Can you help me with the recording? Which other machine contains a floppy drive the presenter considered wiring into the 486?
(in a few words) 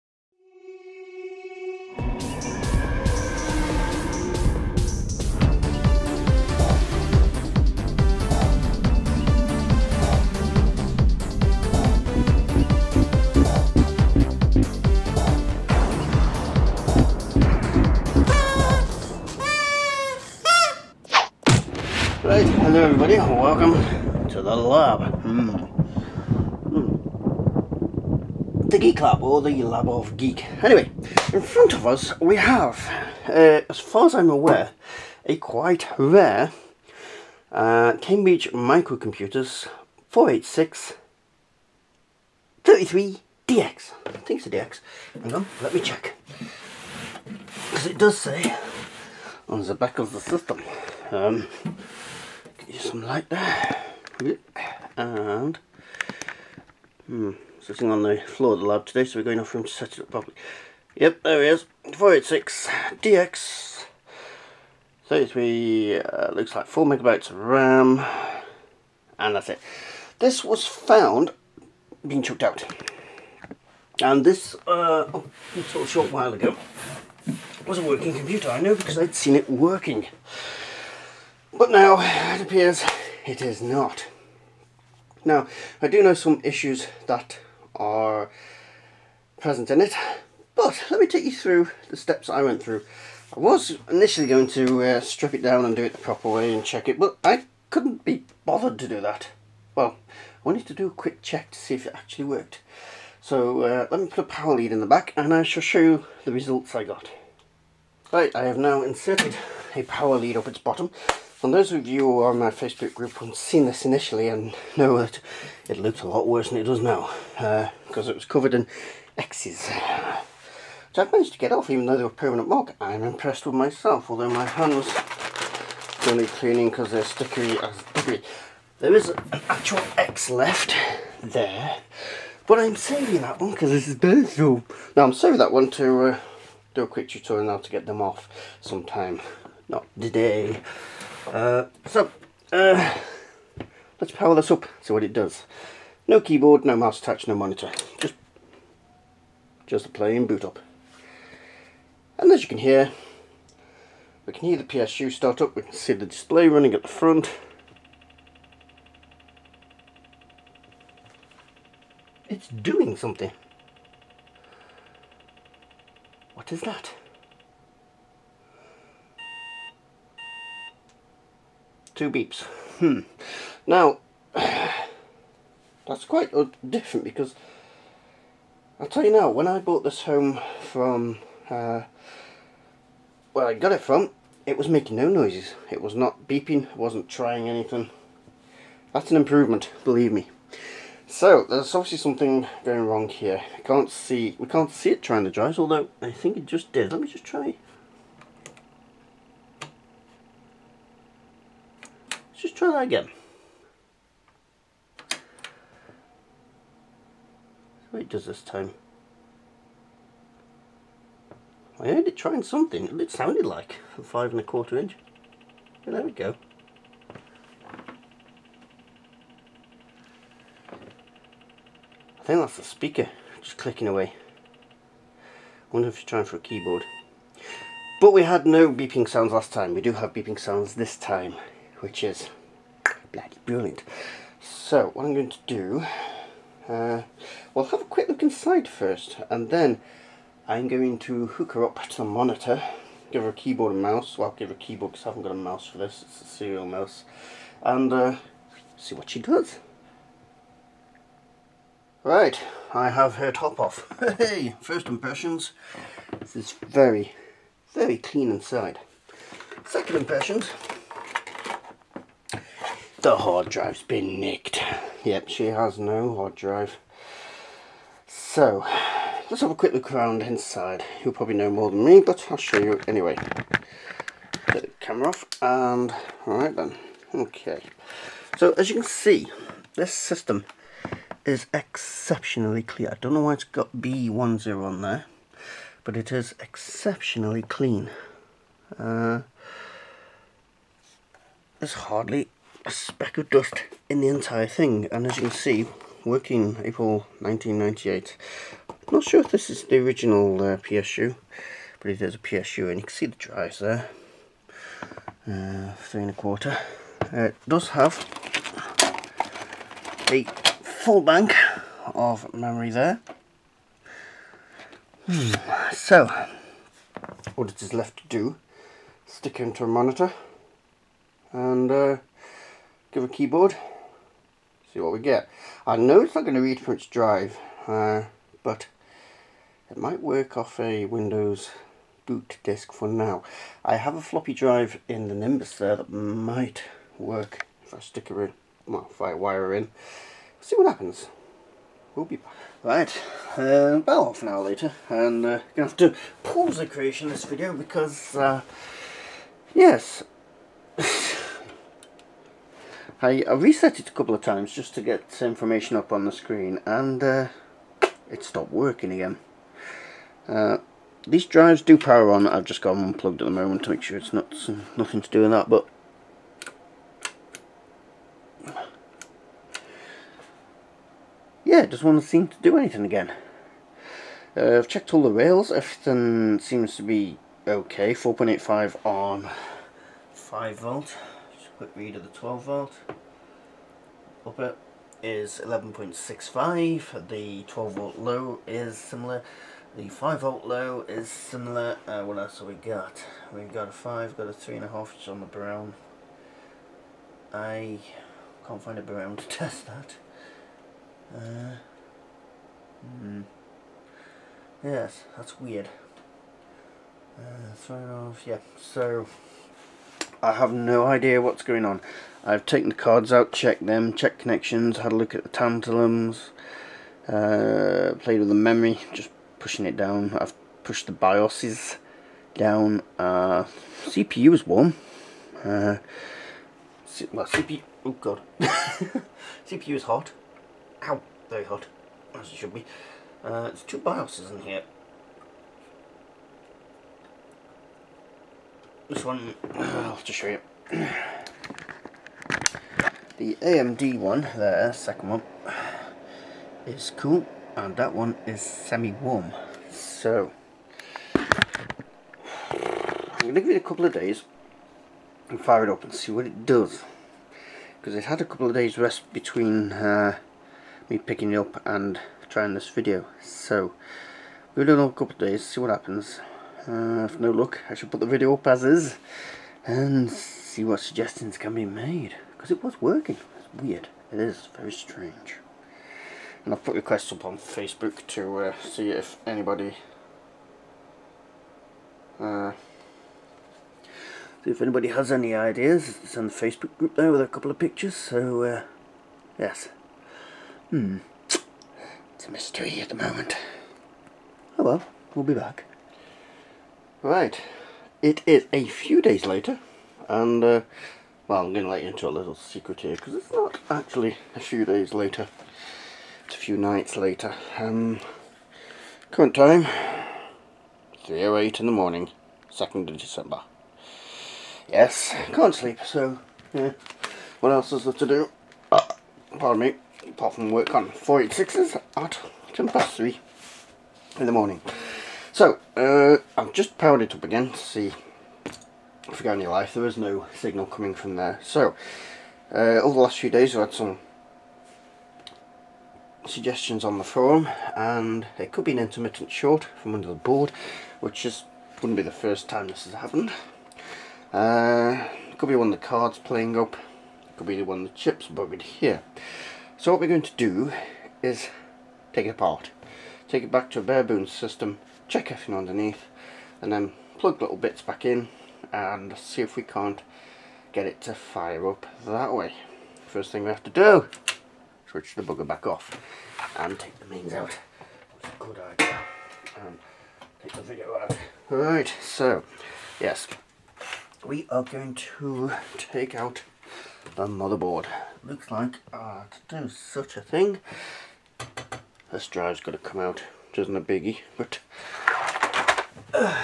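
Nimbus.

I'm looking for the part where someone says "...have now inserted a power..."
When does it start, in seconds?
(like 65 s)
108 s.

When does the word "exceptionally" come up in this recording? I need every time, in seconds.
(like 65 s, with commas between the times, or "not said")
281 s, 286 s.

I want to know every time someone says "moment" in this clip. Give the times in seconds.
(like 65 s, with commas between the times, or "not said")
363 s, 492 s.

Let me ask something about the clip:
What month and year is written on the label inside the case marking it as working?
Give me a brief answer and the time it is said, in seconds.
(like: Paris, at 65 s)
April 1998, at 296 s.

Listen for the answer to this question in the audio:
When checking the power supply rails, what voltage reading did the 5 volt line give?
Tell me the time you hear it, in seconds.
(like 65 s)
377 s.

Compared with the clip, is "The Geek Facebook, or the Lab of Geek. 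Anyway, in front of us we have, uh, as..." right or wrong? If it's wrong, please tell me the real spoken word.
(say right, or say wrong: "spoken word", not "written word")
wrong: "Lab", not "Facebook".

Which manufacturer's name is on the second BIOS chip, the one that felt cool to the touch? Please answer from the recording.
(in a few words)
AMD.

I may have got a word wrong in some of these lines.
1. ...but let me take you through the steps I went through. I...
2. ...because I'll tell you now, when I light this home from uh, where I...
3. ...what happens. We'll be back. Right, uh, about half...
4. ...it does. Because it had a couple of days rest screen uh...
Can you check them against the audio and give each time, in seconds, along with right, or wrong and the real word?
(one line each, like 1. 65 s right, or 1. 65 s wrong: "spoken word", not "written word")
1. 90 s right
2. 177 s wrong: "bought", not "light"
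3. 340 s right
4. 456 s wrong: "between", not "screen".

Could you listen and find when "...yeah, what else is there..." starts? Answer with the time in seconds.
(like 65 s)
516 s.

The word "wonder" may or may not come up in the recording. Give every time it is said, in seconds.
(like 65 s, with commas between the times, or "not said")
225 s.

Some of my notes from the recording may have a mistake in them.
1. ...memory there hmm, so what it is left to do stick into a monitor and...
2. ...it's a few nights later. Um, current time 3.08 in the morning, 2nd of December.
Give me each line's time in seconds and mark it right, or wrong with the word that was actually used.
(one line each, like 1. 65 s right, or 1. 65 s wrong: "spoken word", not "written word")
1. 312 s right
2. 506 s right.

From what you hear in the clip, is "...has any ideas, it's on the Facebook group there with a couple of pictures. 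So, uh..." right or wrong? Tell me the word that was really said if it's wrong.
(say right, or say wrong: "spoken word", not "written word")
right.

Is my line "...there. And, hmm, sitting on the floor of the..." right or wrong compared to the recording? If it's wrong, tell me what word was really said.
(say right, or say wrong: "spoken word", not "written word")
right.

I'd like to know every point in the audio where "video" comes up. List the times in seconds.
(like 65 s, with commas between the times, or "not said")
347 s, 462 s, 468 s, 570 s.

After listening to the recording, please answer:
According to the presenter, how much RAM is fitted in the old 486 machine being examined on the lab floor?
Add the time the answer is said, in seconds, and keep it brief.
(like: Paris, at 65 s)
4 megabytes, at 66 s.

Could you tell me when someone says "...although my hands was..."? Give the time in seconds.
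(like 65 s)
124 s.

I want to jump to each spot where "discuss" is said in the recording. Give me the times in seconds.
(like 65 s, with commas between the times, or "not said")
not said.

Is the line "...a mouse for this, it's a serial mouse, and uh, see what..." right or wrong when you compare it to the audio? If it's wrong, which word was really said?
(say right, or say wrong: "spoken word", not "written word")
right.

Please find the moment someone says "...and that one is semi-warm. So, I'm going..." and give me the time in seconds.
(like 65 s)
447 s.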